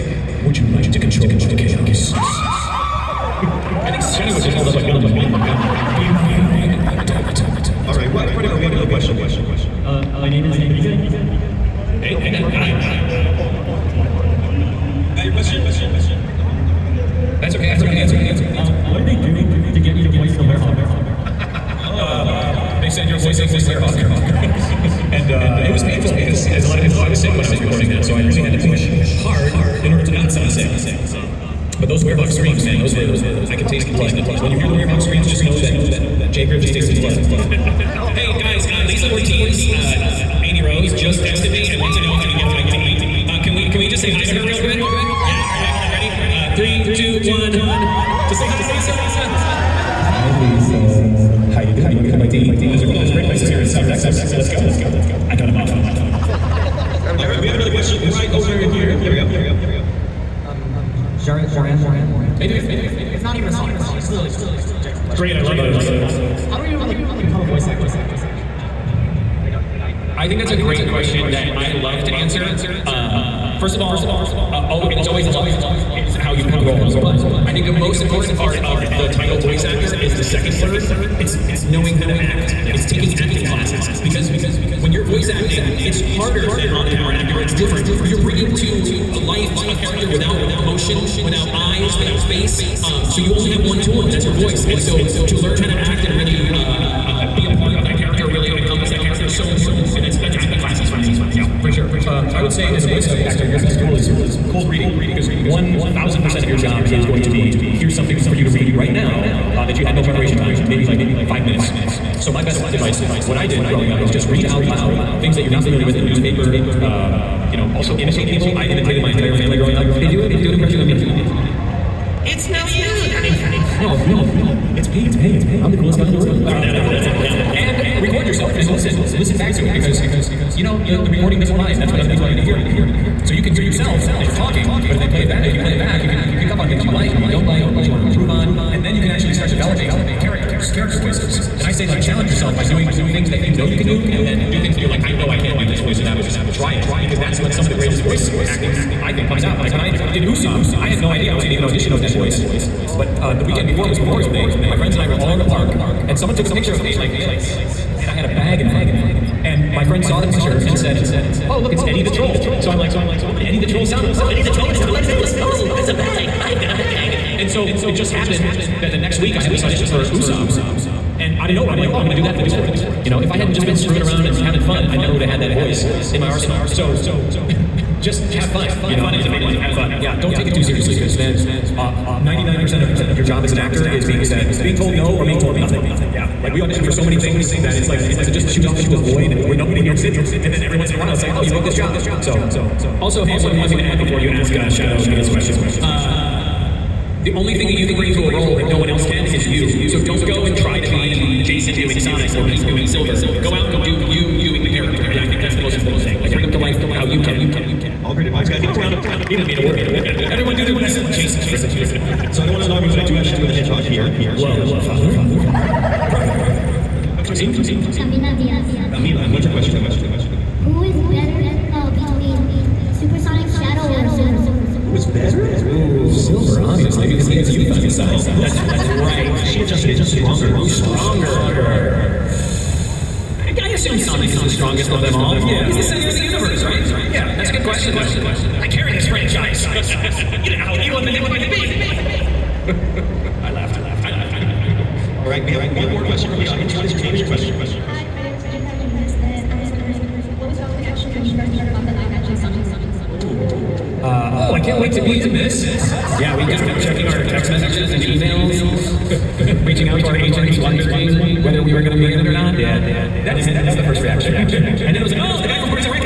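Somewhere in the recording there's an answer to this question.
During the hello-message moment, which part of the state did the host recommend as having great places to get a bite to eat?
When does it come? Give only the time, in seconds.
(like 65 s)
53 s.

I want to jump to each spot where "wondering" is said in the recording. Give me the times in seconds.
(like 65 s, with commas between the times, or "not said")
249 s, 260 s.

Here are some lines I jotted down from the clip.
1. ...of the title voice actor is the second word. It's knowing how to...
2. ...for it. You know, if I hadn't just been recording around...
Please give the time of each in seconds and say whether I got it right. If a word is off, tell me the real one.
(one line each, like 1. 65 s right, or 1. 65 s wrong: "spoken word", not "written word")
1. 78 s right
2. 172 s wrong: "screwing", not "recording".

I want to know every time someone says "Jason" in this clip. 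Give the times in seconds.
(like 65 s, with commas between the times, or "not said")
201 s, 211 s.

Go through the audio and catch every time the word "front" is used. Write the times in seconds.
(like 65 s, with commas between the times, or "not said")
8 s, 158 s.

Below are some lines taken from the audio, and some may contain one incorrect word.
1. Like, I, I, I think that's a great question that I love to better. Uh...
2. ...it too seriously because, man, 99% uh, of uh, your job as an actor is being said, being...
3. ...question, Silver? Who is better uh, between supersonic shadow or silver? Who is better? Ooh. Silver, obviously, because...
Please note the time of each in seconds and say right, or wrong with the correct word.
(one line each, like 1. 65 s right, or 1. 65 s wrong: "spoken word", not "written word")
1. 67 s wrong: "answer", not "better"
2. 180 s right
3. 219 s wrong: "Camila", not "Silver".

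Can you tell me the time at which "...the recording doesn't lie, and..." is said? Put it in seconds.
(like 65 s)
131 s.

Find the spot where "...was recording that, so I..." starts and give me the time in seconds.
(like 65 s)
27 s.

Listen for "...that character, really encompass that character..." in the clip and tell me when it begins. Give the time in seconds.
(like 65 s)
97 s.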